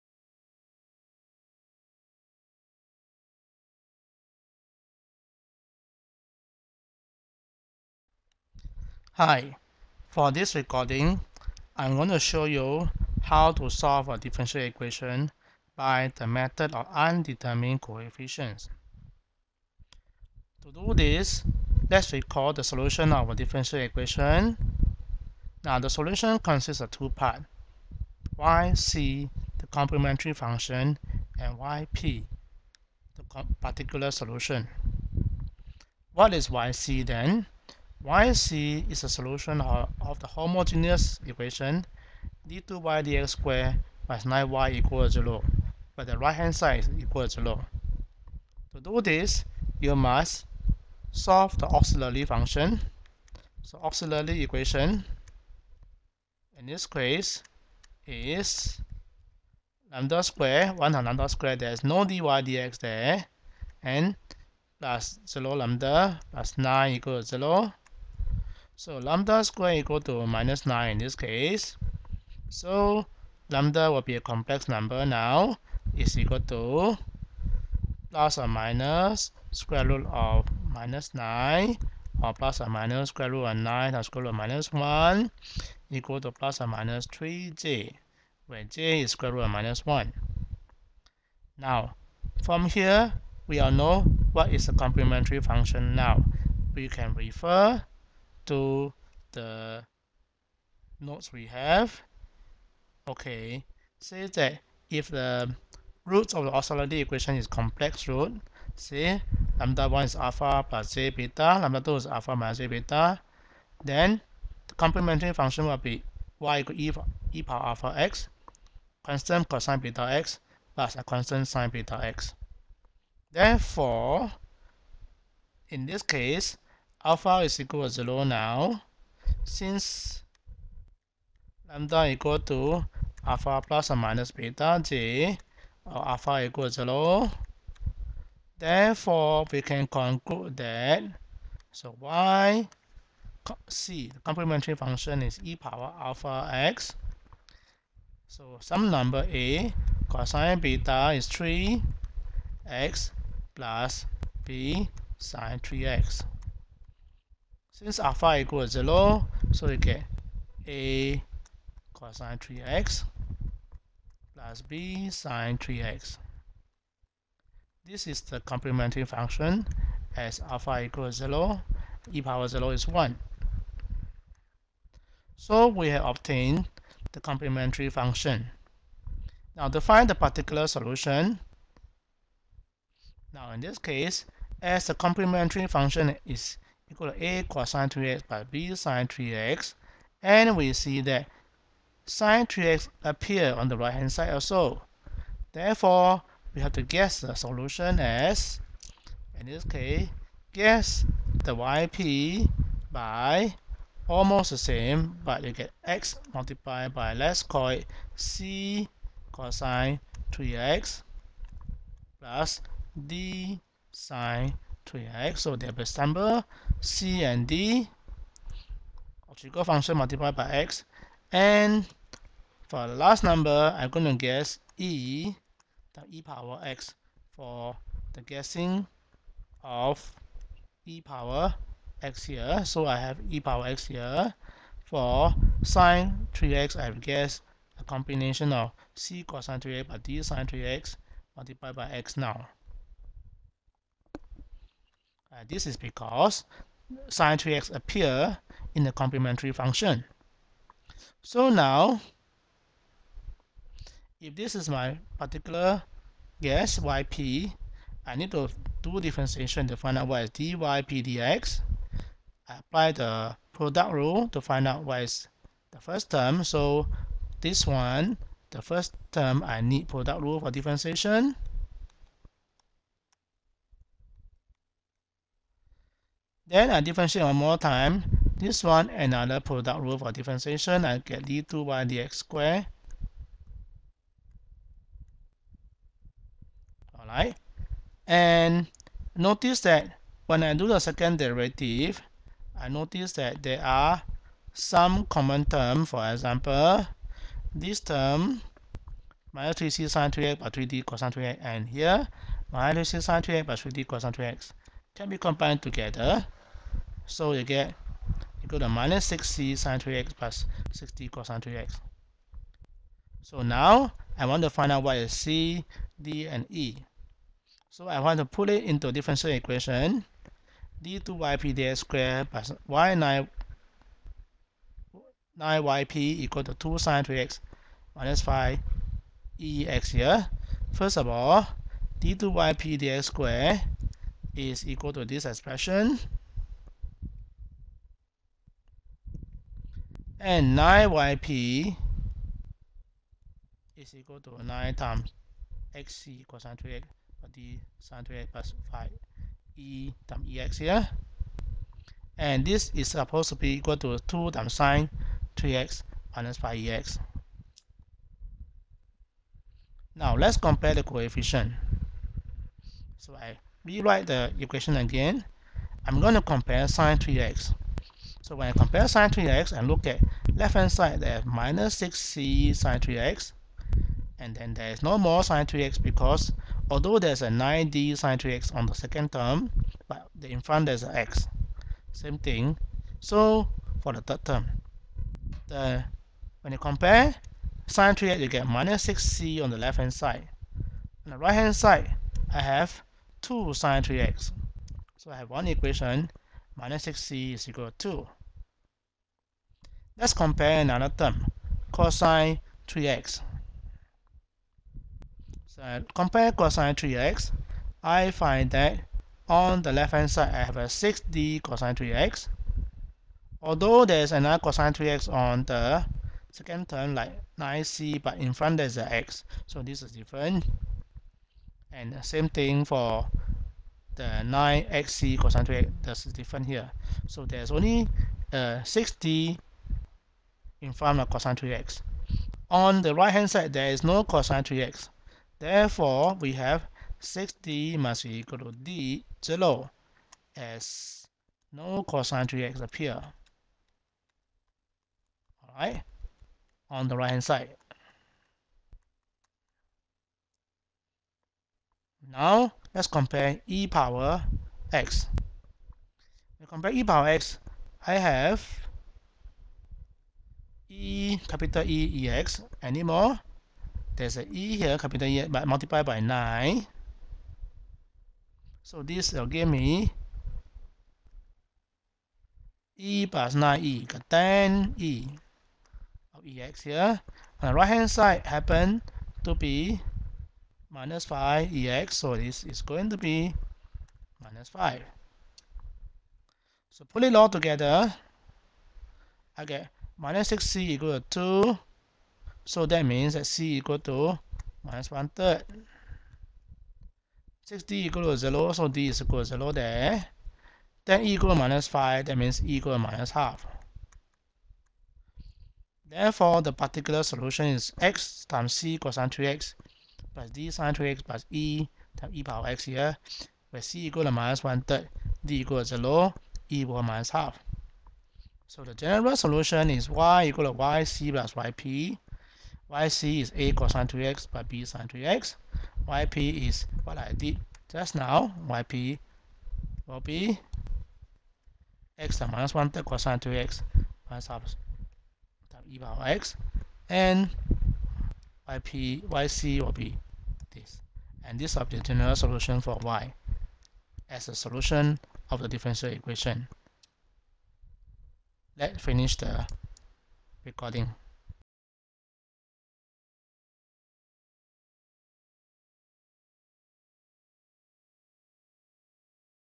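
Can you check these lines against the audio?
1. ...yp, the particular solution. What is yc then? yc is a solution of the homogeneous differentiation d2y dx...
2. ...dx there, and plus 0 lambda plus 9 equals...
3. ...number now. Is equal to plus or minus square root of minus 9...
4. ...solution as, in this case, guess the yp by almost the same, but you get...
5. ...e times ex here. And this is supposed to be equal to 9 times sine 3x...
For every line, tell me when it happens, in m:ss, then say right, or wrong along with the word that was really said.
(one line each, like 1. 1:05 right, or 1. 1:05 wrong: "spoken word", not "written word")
1. 0:31 wrong: "equation", not "differentiation"
2. 1:02 right
3. 1:14 right
4. 3:17 right
5. 5:49 wrong: "2", not "9".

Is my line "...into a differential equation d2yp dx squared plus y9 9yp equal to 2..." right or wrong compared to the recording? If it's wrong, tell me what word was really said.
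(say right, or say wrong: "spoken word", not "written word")
right.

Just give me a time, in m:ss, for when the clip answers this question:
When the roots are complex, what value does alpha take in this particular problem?
2:07.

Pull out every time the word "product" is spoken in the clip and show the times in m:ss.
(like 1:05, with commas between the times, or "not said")
4:23, 4:29, 4:39.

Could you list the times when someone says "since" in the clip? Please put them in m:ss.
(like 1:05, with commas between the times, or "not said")
2:09, 2:37.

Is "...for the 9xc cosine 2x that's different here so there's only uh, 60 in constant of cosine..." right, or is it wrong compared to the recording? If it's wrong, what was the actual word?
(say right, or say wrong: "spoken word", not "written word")
wrong: "front", not "constant".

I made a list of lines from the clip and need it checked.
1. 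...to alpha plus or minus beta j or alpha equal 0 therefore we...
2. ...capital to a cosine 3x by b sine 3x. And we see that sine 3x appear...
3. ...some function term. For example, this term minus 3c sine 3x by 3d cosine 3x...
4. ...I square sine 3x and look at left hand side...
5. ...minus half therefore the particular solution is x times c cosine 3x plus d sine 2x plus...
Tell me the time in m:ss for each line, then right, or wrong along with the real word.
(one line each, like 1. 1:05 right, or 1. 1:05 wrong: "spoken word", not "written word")
1. 2:12 right
2. 3:06 wrong: "equal", not "capital"
3. 4:54 wrong: "common", not "function"
4. 6:08 wrong: "compare", not "square"
5. 8:22 right.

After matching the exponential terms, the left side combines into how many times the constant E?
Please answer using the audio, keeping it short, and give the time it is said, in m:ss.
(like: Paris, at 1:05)
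10, at 7:54.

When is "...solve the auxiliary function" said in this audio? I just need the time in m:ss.
0:51.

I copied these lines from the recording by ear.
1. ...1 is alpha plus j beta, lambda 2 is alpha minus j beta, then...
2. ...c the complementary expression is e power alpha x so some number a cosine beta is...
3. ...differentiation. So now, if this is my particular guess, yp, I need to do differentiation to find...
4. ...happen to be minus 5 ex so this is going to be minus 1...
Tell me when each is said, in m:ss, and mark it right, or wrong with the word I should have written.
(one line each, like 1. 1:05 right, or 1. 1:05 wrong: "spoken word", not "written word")
1. 1:49 right
2. 2:23 wrong: "function", not "expression"
3. 4:09 wrong: "function", not "differentiation"
4. 7:58 wrong: "5", not "1".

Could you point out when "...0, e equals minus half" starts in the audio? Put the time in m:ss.
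8:35.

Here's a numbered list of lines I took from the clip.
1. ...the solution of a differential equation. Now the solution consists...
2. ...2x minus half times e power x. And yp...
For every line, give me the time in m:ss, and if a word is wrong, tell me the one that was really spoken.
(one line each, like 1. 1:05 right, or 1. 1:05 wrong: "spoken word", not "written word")
1. 0:22 right
2. 8:53 right.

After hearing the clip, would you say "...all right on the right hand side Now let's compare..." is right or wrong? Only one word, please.
right.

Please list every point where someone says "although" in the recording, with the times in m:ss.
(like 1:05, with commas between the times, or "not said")
6:16, 6:53.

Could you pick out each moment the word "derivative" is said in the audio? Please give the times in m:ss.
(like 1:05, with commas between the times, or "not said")
4:51.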